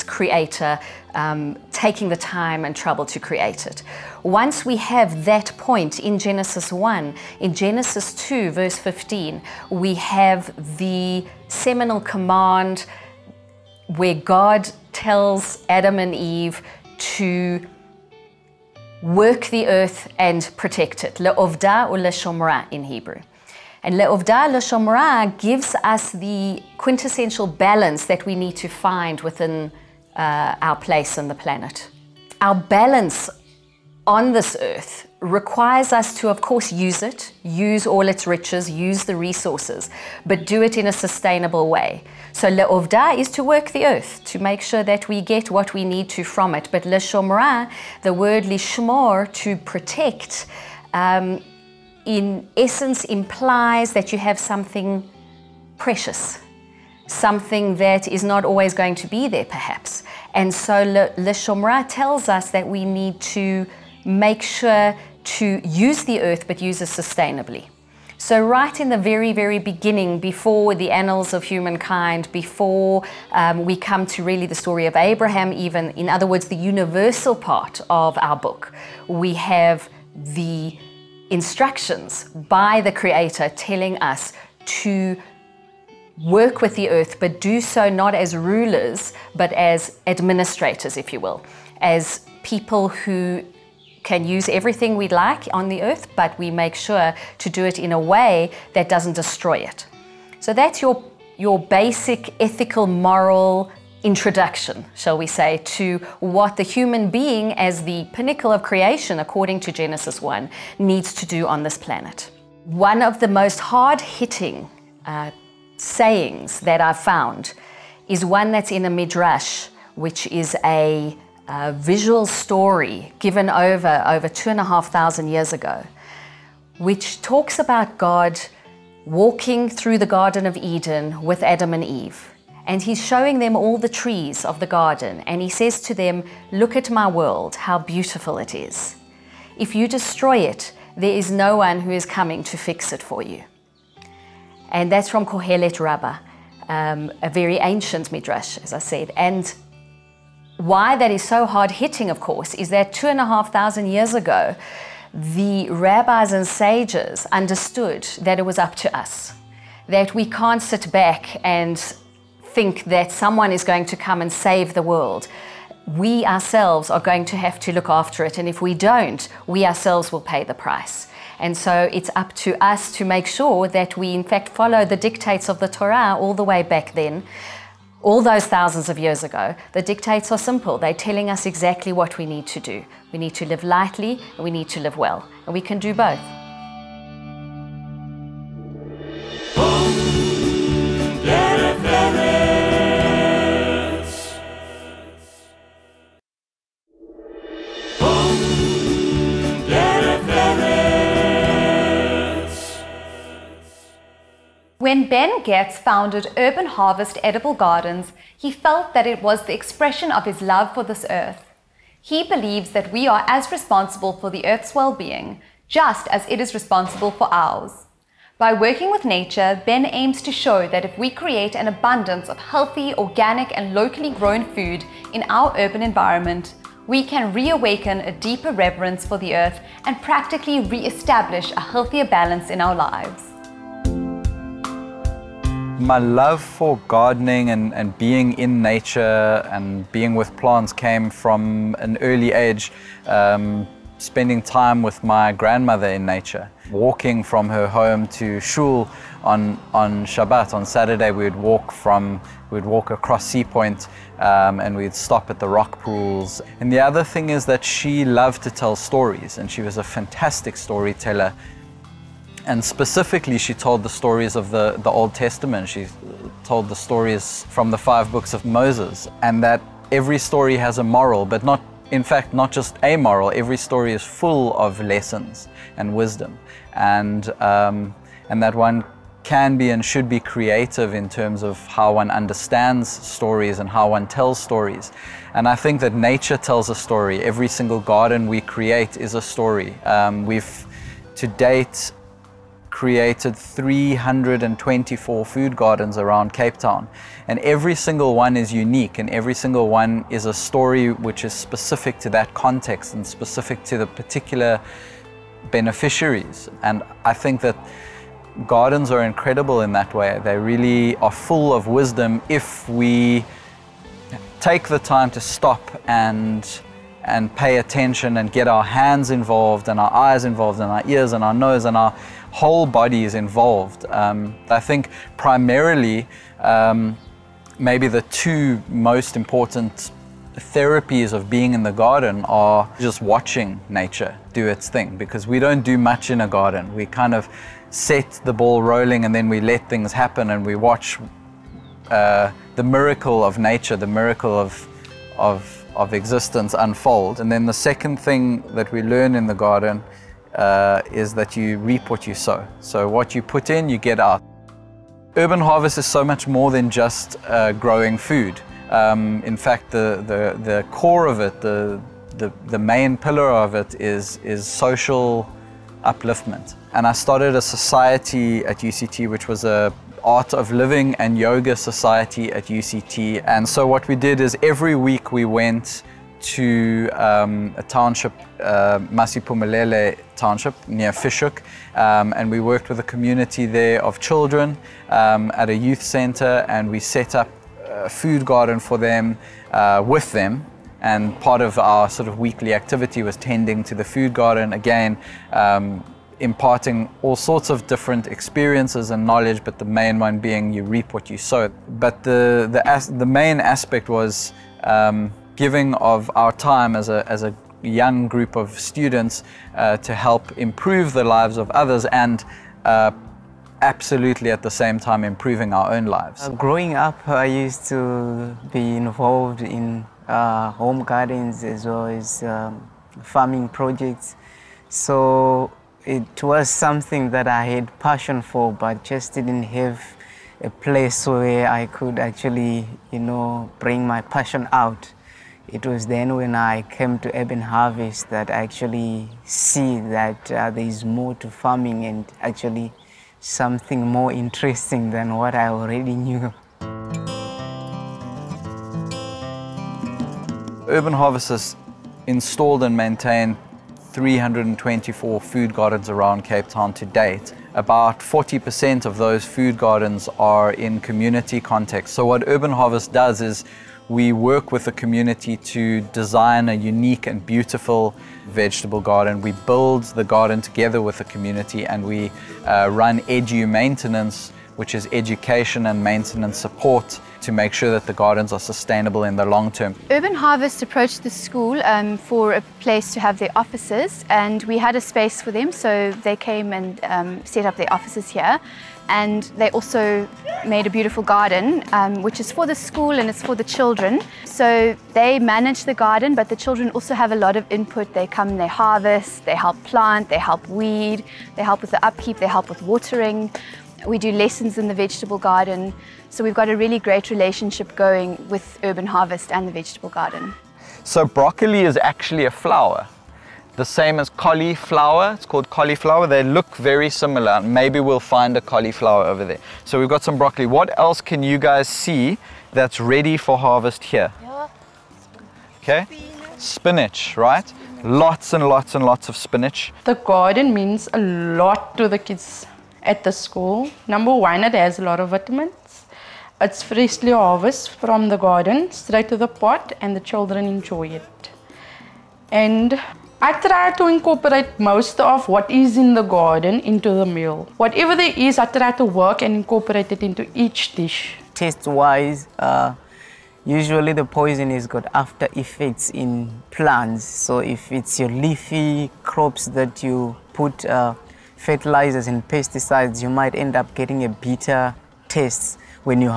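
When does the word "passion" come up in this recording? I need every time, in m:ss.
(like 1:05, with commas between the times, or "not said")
7:07, 7:14.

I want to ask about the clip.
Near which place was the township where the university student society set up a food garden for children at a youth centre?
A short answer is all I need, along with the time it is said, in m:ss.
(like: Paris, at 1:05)
Fish Hoek, at 6:20.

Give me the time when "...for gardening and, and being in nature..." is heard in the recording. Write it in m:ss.
3:56.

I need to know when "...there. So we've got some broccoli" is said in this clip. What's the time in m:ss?
8:39.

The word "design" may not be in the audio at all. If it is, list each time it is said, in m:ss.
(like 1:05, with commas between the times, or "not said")
7:45.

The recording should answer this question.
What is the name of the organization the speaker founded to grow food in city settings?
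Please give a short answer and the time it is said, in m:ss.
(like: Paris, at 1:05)
Urban Harvest Edible Gardens, at 3:26.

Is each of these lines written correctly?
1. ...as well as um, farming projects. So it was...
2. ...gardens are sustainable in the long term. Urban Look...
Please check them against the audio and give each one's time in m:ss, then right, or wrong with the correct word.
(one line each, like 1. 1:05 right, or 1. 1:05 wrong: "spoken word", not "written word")
1. 7:01 right
2. 7:57 wrong: "Harvest", not "Look".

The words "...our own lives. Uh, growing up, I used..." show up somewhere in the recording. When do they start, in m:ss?
6:55.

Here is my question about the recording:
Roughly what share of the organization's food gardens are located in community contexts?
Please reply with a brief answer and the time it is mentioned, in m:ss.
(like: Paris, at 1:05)
40%, at 7:37.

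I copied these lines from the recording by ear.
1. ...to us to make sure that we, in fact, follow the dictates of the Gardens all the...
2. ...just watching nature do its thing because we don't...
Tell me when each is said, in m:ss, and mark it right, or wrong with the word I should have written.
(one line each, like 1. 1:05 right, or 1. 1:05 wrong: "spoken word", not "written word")
1. 2:52 wrong: "Torah", not "Gardens"
2. 5:32 right.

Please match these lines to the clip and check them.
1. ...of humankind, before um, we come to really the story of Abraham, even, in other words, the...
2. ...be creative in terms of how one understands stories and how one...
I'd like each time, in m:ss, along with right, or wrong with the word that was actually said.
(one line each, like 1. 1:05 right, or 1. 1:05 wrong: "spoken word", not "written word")
1. 1:11 right
2. 4:40 right.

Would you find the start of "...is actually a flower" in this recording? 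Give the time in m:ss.
8:31.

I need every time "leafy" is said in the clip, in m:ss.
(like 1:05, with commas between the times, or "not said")
9:18.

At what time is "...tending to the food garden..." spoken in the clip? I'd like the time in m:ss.
6:33.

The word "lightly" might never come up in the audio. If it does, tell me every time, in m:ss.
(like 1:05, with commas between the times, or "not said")
3:03.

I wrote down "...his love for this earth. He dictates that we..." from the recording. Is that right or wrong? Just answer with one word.
wrong.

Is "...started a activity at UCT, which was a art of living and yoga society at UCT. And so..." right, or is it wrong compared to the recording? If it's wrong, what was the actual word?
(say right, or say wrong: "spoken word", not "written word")
wrong: "society", not "activity".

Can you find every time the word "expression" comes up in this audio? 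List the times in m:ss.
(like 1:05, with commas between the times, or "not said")
3:29.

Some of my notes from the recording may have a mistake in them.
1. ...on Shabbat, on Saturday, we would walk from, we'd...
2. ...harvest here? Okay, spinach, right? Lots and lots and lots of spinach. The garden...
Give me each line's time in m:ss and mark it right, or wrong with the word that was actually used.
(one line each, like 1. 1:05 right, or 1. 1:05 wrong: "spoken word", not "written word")
1. 4:09 right
2. 8:43 right.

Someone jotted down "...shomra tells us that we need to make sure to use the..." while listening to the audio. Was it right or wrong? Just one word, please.
right.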